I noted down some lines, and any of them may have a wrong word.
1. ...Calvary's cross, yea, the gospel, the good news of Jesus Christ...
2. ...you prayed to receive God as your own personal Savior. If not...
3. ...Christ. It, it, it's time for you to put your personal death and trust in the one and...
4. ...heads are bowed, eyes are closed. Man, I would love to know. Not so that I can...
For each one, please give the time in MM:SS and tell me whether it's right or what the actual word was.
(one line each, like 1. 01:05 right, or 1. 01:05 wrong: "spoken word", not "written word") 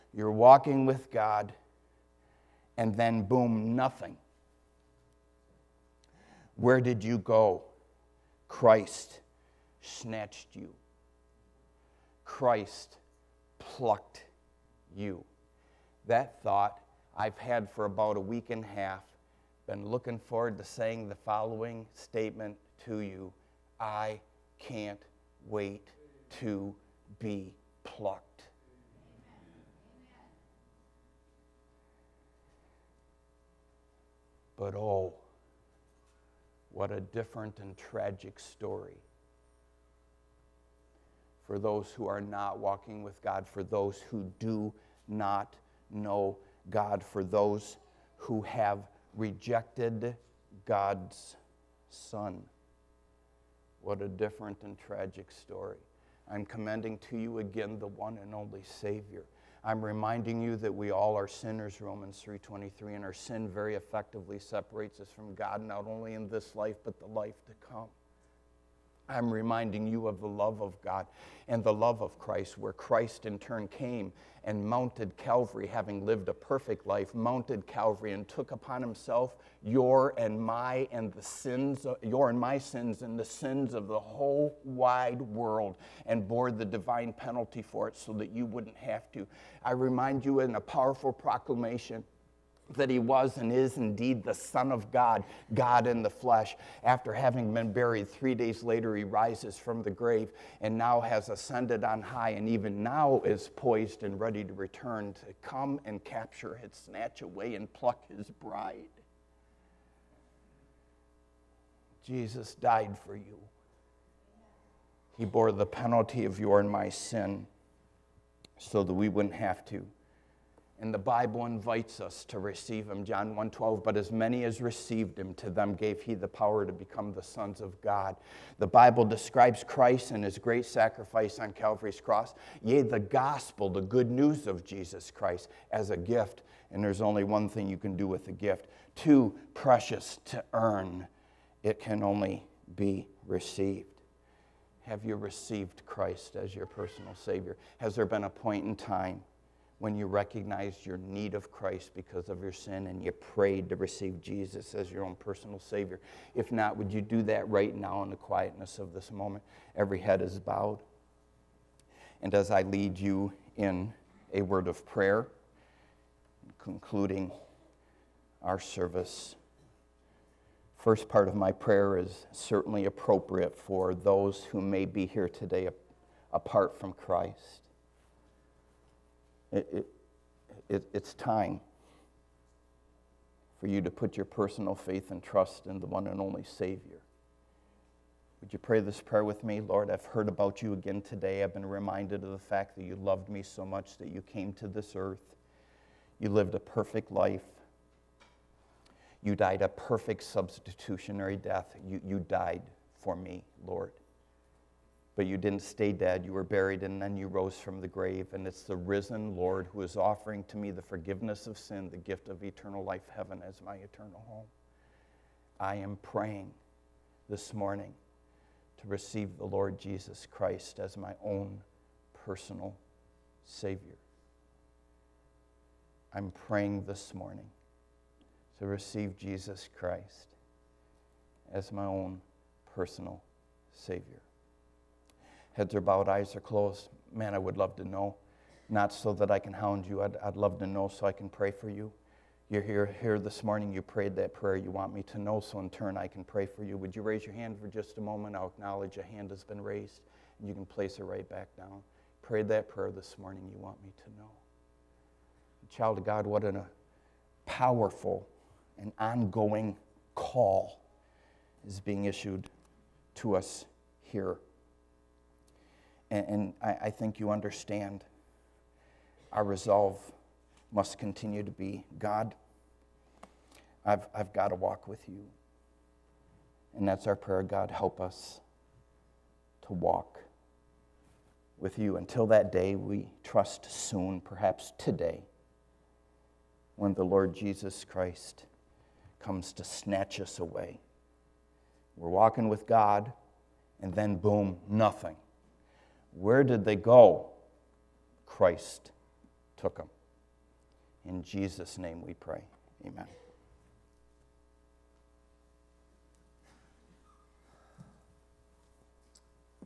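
1. 02:11 right
2. 02:33 wrong: "Jesus", not "God"
3. 02:56 wrong: "faith", not "death"
4. 03:55 right.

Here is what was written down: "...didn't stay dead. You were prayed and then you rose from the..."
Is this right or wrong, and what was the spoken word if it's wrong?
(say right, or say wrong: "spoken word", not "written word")
wrong: "buried", not "prayed".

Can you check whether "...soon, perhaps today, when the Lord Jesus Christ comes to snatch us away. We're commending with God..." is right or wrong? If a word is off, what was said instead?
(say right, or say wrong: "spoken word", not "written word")
wrong: "walking", not "commending".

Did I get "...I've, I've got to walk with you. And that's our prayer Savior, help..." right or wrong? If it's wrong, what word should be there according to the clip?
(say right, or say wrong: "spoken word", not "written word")
wrong: "God", not "Savior".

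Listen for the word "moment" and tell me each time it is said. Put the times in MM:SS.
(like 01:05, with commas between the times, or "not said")
02:39, 04:07.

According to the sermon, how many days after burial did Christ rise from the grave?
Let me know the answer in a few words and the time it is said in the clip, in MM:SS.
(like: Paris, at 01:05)
3, at 01:38.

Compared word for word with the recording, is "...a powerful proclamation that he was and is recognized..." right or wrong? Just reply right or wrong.
wrong.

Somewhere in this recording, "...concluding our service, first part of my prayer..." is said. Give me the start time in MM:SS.
02:46.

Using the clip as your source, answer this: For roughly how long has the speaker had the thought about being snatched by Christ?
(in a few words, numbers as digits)
a week and a half.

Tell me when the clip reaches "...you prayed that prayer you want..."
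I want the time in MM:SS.
04:03.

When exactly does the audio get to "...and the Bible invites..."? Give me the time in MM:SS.
02:00.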